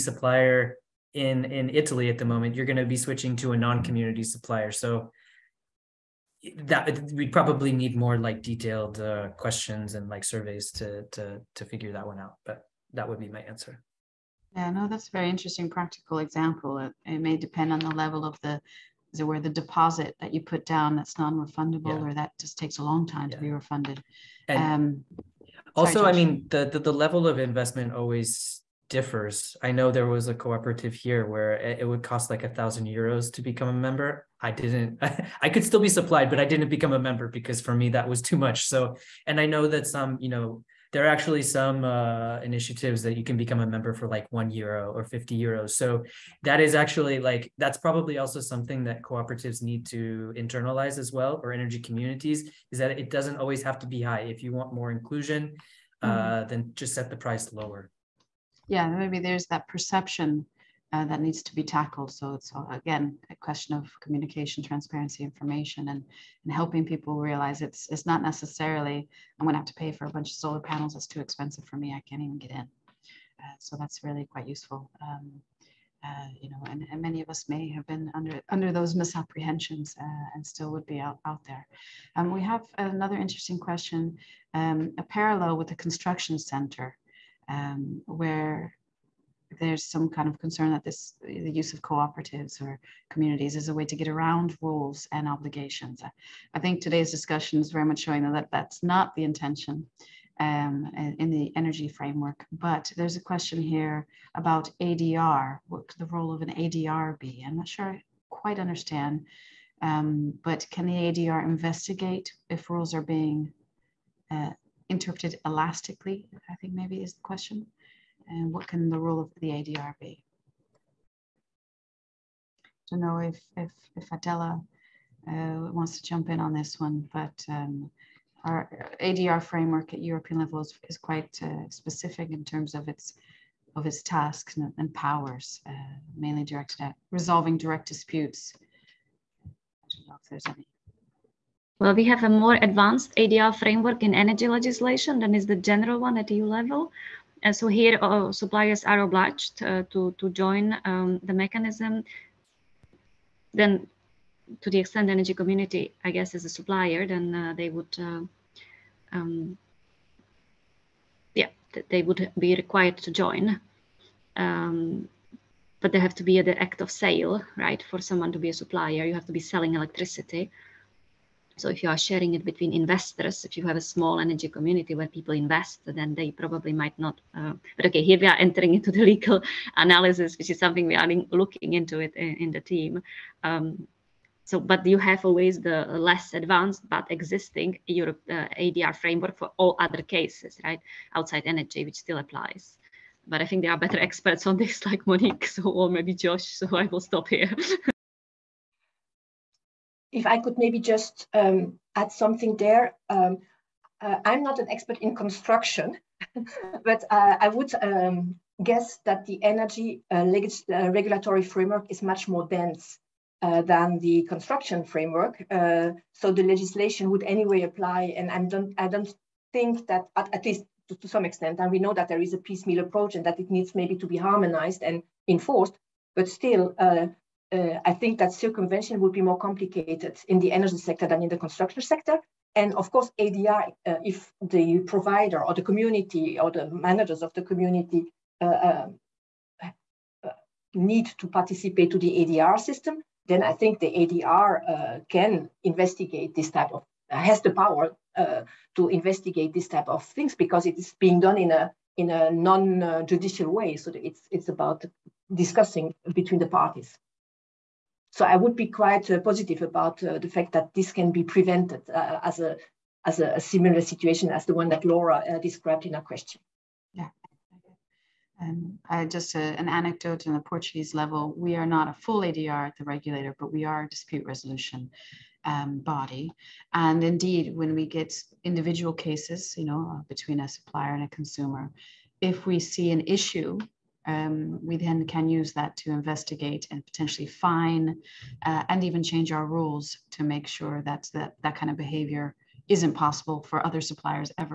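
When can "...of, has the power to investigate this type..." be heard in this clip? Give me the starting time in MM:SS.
04:06.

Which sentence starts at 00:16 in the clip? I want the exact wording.
It, it may depend on the level of the is it where the deposit that you put down that's non-refundable yeah.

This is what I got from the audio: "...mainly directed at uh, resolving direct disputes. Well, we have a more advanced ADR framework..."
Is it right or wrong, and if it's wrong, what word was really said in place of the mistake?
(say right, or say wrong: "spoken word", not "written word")
right.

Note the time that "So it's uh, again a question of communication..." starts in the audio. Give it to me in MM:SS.
01:02.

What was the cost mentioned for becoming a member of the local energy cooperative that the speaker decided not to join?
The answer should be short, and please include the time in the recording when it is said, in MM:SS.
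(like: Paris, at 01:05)
1000 euros, at 00:32.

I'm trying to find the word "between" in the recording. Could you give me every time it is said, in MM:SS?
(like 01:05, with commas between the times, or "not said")
02:52, 04:16, 04:40.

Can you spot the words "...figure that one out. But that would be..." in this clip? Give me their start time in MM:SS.
00:11.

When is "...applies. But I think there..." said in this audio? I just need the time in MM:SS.
03:12.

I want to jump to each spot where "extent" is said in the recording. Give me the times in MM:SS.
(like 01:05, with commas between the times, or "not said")
02:34, 03:41.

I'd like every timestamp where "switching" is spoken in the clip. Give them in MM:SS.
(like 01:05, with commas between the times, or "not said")
00:02.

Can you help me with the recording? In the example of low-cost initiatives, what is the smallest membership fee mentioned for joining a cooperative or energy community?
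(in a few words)
1 euro.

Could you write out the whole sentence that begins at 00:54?
If you want more inclusion, mm-hmm.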